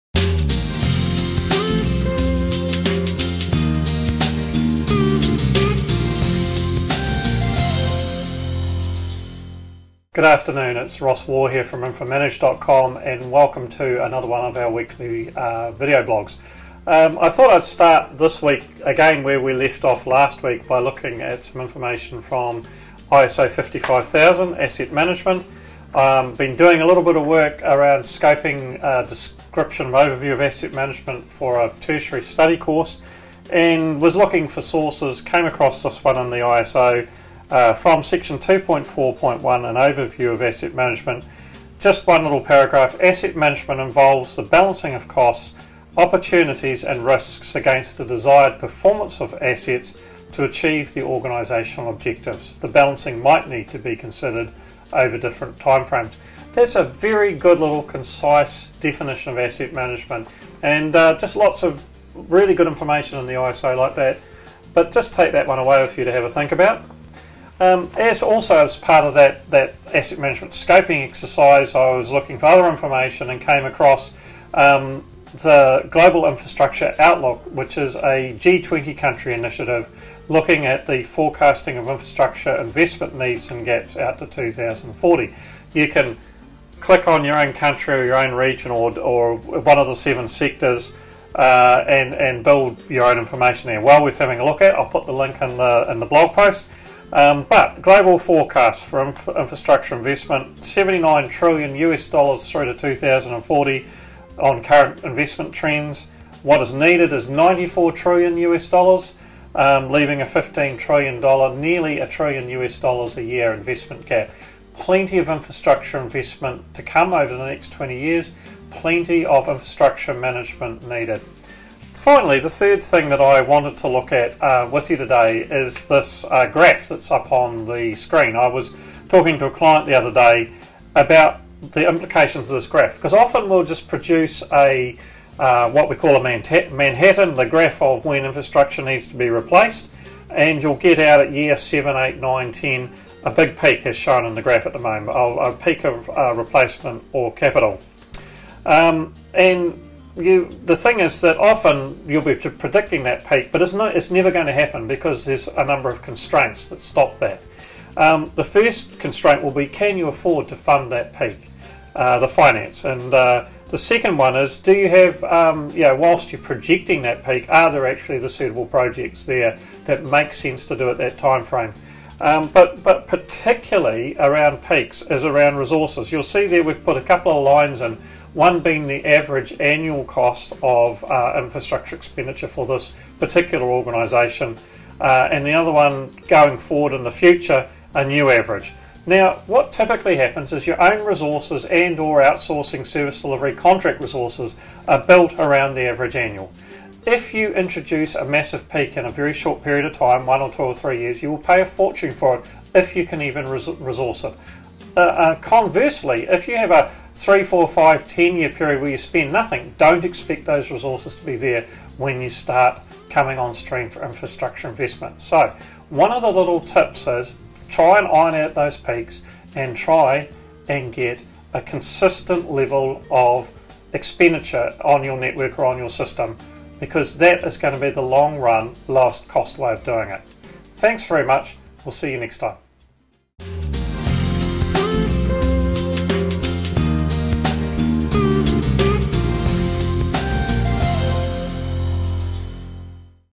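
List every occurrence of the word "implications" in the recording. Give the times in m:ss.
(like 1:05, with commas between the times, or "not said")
2:11.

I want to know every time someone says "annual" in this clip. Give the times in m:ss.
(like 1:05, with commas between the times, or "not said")
2:59, 3:16.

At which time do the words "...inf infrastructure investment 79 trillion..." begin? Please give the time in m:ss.
1:39.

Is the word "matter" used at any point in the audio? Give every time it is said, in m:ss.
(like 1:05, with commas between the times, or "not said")
not said.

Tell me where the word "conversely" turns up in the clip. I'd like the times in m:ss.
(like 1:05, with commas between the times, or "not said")
3:25.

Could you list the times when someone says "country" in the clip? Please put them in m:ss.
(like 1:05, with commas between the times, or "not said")
1:18, 1:27.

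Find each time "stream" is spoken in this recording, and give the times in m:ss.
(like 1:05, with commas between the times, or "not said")
3:33.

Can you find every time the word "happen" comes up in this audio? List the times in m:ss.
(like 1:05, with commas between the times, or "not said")
2:34, 3:10.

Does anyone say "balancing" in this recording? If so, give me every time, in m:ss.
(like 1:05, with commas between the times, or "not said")
0:44, 0:52.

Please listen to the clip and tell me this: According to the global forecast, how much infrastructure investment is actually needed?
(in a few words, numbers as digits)
94 trillion US dollars.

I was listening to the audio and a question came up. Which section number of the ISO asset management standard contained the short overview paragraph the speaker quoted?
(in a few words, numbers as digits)
2.4.1.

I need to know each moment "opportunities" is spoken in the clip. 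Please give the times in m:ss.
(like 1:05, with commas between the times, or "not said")
0:45.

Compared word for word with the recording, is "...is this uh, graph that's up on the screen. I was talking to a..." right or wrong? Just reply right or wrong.
right.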